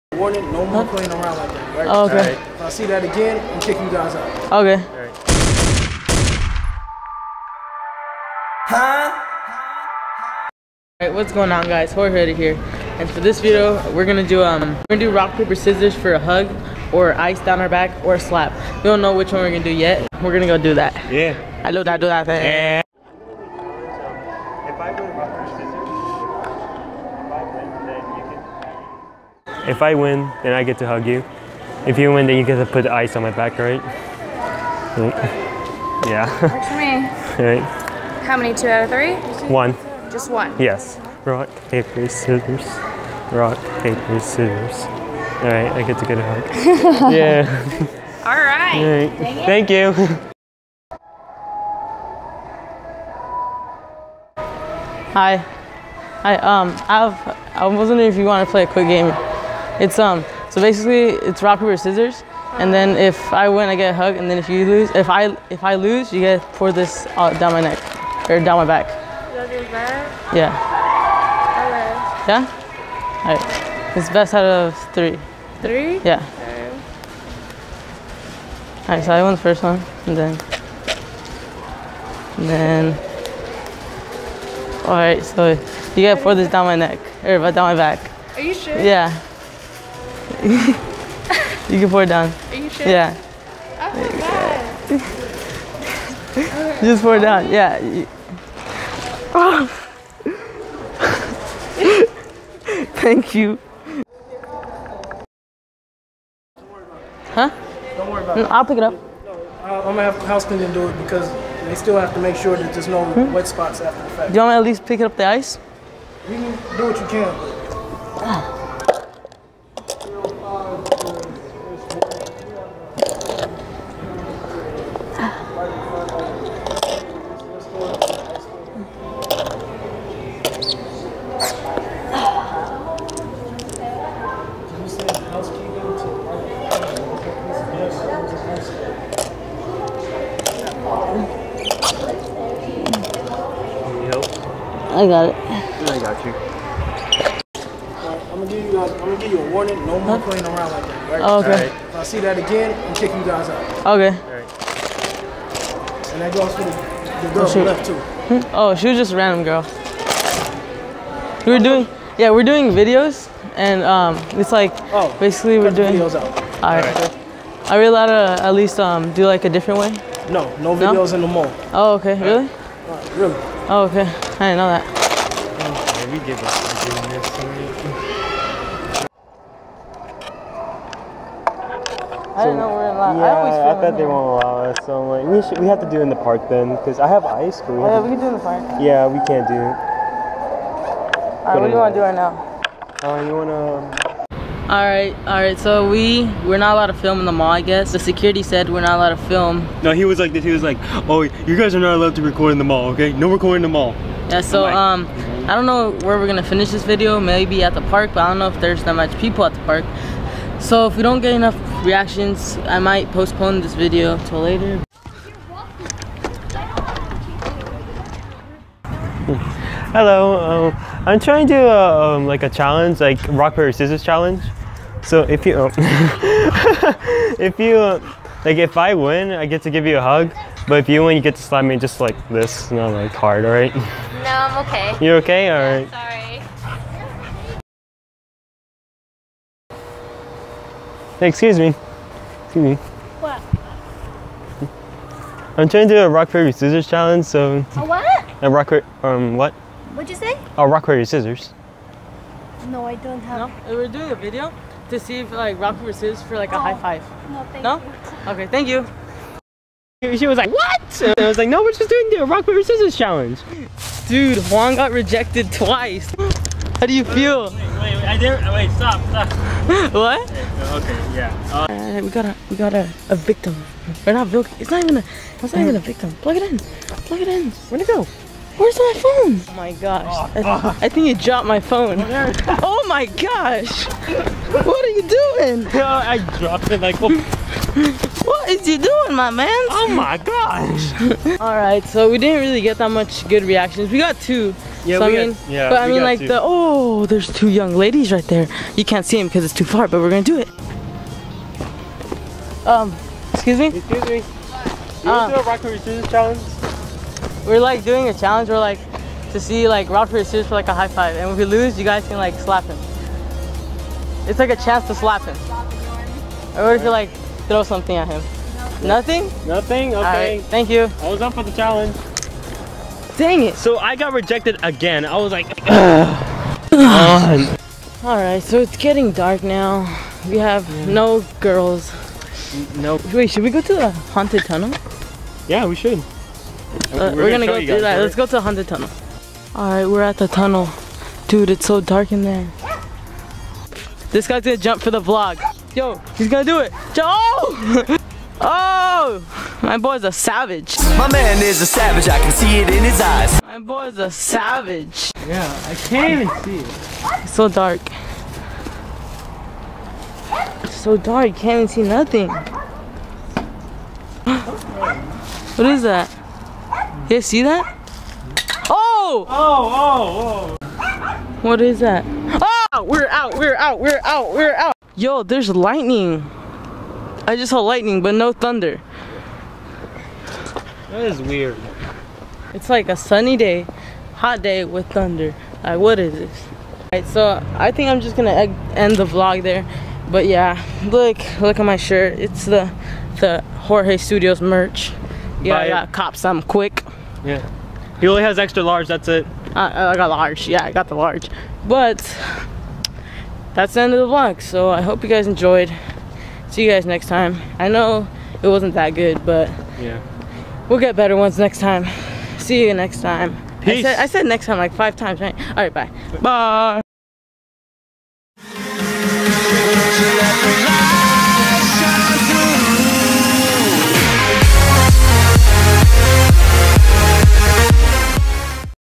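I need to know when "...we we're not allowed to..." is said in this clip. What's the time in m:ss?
3:15.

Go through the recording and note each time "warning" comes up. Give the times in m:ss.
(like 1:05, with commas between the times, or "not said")
0:00, 2:29.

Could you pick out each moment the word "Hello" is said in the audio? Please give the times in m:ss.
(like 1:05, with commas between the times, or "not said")
3:39.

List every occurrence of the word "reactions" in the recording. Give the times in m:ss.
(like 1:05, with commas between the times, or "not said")
3:31, 4:53.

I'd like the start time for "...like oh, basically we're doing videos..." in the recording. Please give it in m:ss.
2:44.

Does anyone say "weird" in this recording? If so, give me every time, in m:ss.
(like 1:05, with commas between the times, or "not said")
6:21.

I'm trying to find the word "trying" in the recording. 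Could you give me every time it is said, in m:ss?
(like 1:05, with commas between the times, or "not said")
3:41, 4:05.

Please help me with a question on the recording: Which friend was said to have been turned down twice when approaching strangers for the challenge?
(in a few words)
Juan.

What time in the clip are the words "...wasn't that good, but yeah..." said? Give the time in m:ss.
6:48.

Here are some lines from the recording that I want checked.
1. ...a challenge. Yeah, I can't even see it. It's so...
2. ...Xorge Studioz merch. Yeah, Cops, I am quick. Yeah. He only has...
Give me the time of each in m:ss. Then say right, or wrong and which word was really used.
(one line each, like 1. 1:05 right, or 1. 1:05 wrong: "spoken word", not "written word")
1. 5:53 wrong: "savage", not "challenge"
2. 6:33 right.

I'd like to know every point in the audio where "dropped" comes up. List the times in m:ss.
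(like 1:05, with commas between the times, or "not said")
4:41, 4:46.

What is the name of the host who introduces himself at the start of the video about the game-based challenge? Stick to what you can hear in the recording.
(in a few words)
Jorge.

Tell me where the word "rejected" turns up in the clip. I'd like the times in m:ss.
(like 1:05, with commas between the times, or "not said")
4:24, 5:24.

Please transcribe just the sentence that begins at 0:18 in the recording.
We don't know which one we're gonna do yet.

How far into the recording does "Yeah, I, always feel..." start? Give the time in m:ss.
3:03.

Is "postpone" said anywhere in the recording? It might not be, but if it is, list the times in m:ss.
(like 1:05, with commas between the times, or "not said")
3:33.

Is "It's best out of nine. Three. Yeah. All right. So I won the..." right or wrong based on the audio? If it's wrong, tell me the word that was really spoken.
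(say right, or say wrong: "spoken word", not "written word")
wrong: "three", not "nine".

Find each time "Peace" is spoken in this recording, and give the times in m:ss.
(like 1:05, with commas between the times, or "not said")
6:53.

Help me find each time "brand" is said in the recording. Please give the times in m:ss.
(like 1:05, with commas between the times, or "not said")
not said.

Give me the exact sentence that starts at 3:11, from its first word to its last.
Alright, what do you want to do right now?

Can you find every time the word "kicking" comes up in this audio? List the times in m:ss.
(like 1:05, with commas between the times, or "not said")
0:03, 2:32.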